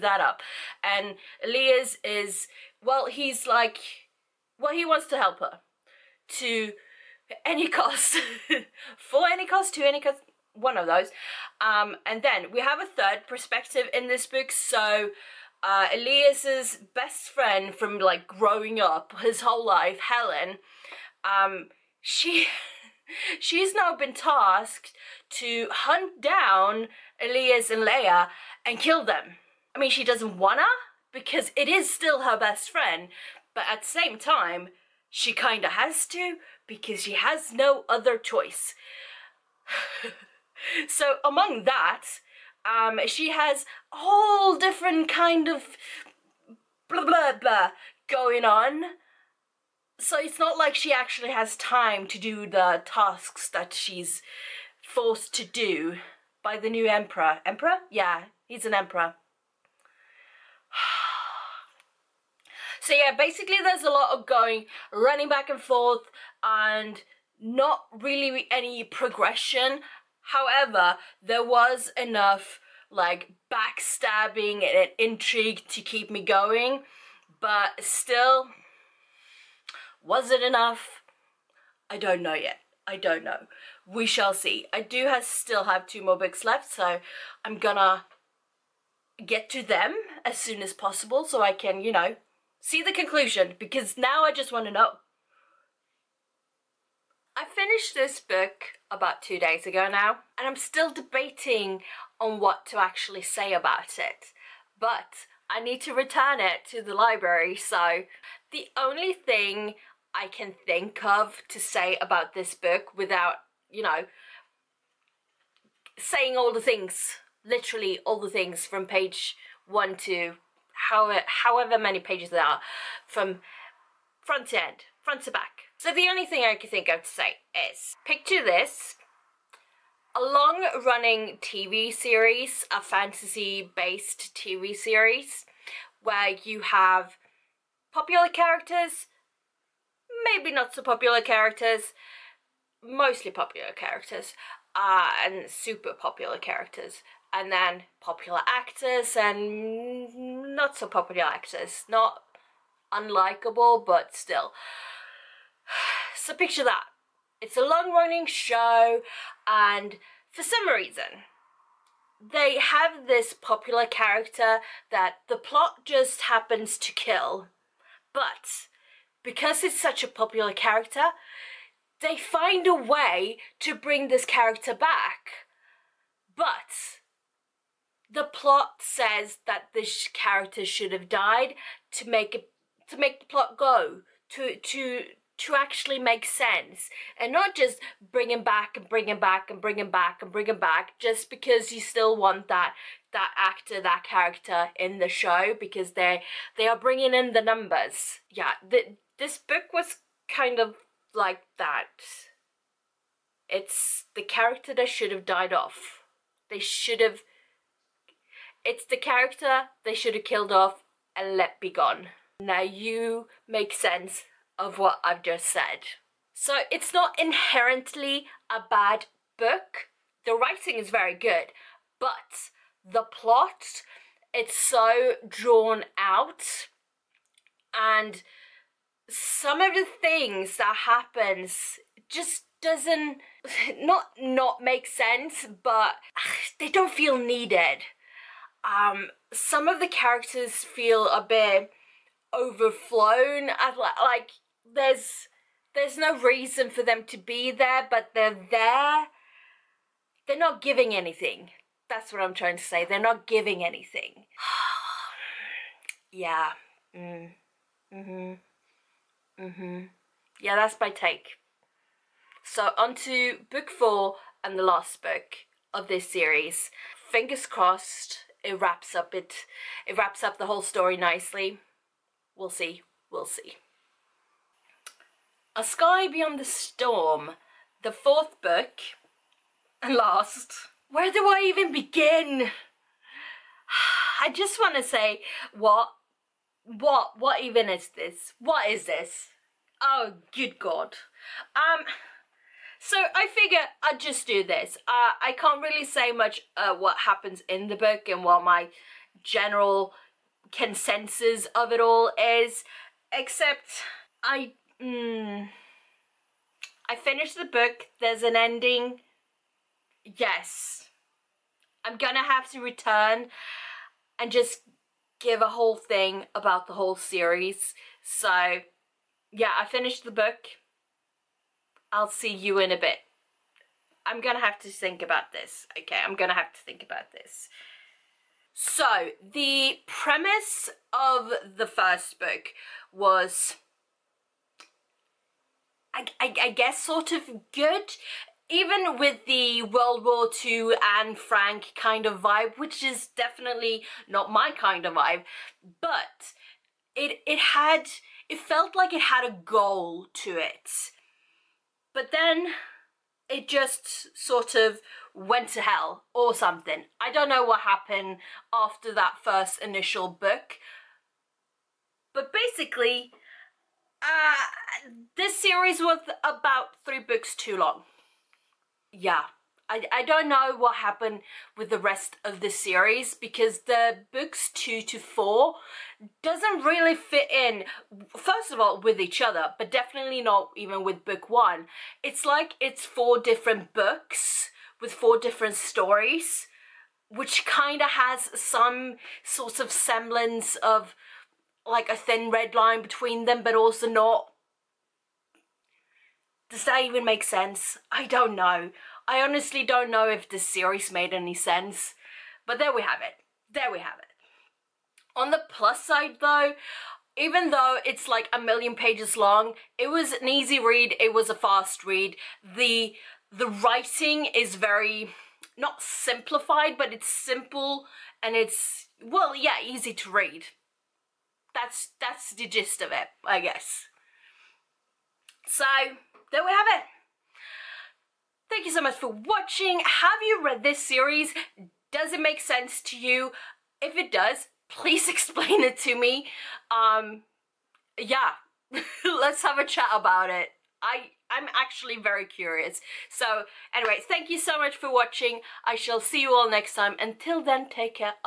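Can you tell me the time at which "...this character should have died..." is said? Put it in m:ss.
2:59.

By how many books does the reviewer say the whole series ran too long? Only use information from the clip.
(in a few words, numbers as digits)
3.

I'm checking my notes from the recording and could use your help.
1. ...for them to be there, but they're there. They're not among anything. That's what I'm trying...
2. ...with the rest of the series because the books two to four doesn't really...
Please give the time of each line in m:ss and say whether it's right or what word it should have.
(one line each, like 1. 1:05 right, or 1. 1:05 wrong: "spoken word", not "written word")
1. 4:06 wrong: "giving", not "among"
2. 6:11 right.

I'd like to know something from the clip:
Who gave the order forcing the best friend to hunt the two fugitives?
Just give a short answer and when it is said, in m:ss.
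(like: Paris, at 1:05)
the new emperor, at 0:56.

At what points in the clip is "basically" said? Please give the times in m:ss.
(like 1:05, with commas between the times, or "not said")
1:03, 6:02.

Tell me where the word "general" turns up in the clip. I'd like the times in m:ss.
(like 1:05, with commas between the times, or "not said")
4:59.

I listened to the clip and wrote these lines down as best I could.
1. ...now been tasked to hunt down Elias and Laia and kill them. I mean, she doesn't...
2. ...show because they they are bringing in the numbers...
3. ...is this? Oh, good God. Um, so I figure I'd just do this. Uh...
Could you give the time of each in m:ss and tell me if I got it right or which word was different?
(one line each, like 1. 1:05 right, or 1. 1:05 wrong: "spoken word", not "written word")
1. 0:23 right
2. 3:15 right
3. 4:48 right.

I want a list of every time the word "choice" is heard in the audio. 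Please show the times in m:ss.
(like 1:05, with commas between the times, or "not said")
0:38.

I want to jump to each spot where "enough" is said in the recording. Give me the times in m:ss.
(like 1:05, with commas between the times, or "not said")
1:12, 1:20.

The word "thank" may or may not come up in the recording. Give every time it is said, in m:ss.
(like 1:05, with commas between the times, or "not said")
7:08, 7:24.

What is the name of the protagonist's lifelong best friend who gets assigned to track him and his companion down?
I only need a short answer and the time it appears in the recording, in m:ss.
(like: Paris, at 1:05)
Helen, at 0:19.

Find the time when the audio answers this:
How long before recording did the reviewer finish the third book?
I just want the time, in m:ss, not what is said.
1:38.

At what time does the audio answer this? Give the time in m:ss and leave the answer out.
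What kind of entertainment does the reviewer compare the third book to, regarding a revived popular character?
2:10.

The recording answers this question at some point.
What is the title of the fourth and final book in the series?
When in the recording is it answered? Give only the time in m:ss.
4:35.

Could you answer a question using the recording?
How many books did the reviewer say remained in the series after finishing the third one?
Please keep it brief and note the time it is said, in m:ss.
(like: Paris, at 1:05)
2, at 1:25.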